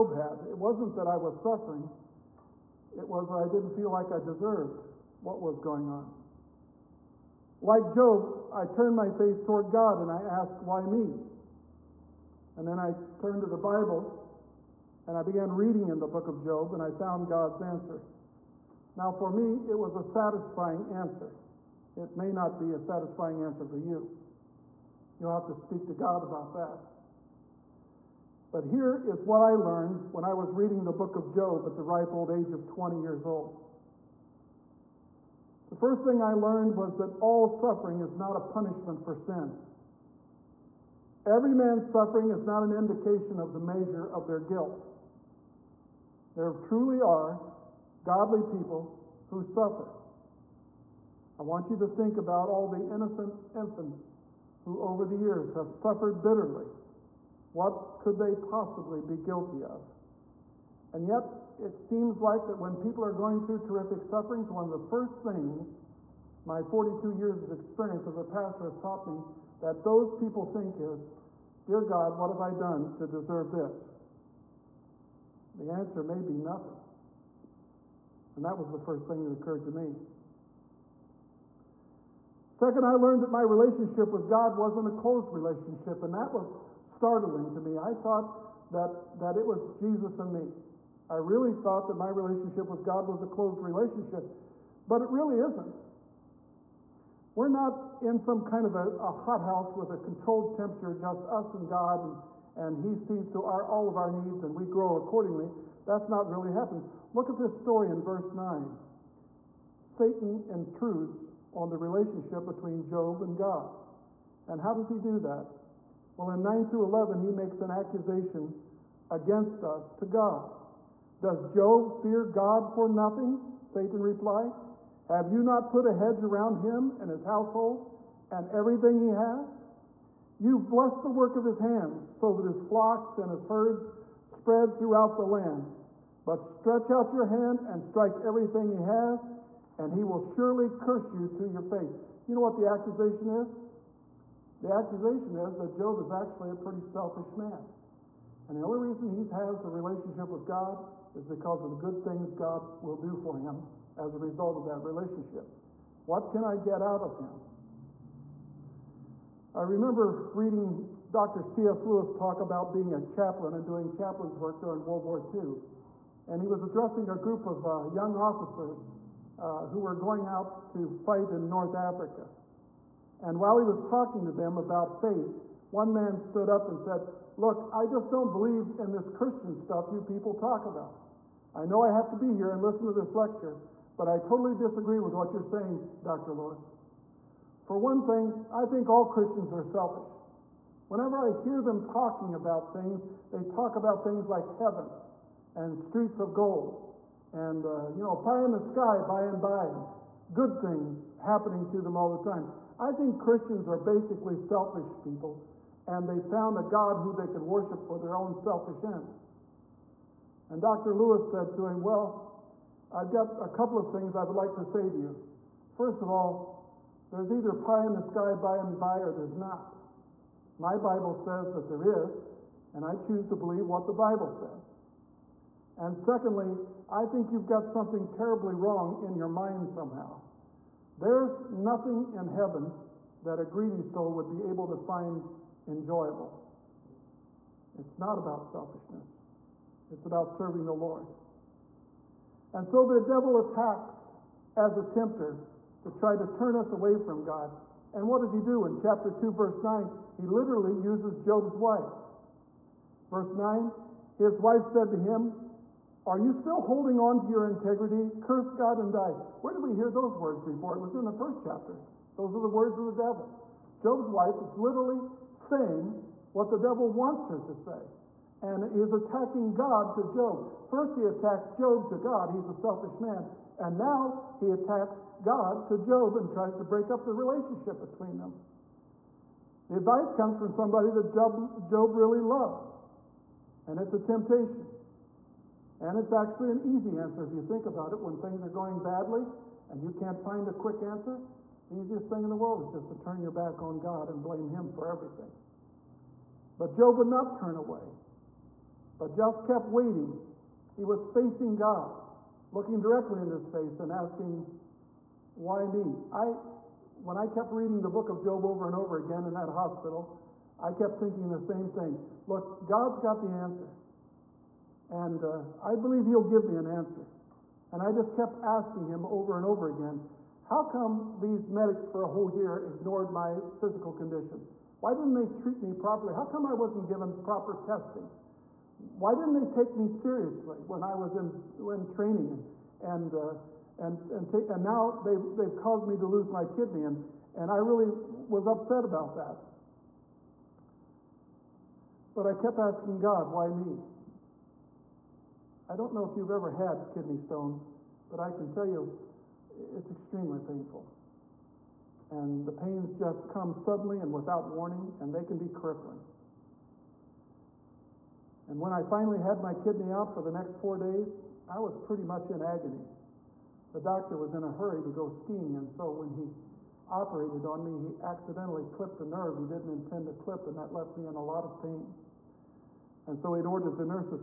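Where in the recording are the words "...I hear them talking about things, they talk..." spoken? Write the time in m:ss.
3:11.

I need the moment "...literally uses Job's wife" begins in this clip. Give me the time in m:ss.
4:10.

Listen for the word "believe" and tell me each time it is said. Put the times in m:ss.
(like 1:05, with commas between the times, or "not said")
2:58, 3:43, 5:15.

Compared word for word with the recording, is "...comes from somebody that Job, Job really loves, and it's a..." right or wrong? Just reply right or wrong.
right.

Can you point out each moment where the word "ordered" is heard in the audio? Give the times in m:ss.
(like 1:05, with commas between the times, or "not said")
6:13.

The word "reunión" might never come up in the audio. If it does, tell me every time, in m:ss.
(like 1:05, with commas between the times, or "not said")
not said.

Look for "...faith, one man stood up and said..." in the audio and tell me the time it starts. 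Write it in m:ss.
2:55.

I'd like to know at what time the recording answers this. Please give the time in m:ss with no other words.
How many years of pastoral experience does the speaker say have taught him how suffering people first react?
1:06.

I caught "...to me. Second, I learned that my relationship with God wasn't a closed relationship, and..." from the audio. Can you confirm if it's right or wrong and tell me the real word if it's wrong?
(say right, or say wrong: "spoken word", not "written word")
right.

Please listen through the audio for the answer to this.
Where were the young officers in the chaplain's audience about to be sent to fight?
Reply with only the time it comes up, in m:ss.
2:51.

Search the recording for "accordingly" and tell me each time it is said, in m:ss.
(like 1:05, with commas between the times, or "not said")
1:44.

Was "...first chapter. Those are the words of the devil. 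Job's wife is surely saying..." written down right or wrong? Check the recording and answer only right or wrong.
wrong.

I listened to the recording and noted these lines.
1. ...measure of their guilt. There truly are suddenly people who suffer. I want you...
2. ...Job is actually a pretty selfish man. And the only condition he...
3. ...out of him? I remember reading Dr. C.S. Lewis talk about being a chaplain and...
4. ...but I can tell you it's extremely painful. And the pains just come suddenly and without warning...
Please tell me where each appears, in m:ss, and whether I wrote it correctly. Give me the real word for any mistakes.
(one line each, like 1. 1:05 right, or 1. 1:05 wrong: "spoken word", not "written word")
1. 0:43 wrong: "godly", not "suddenly"
2. 2:25 wrong: "reason", not "condition"
3. 2:36 right
4. 5:48 right.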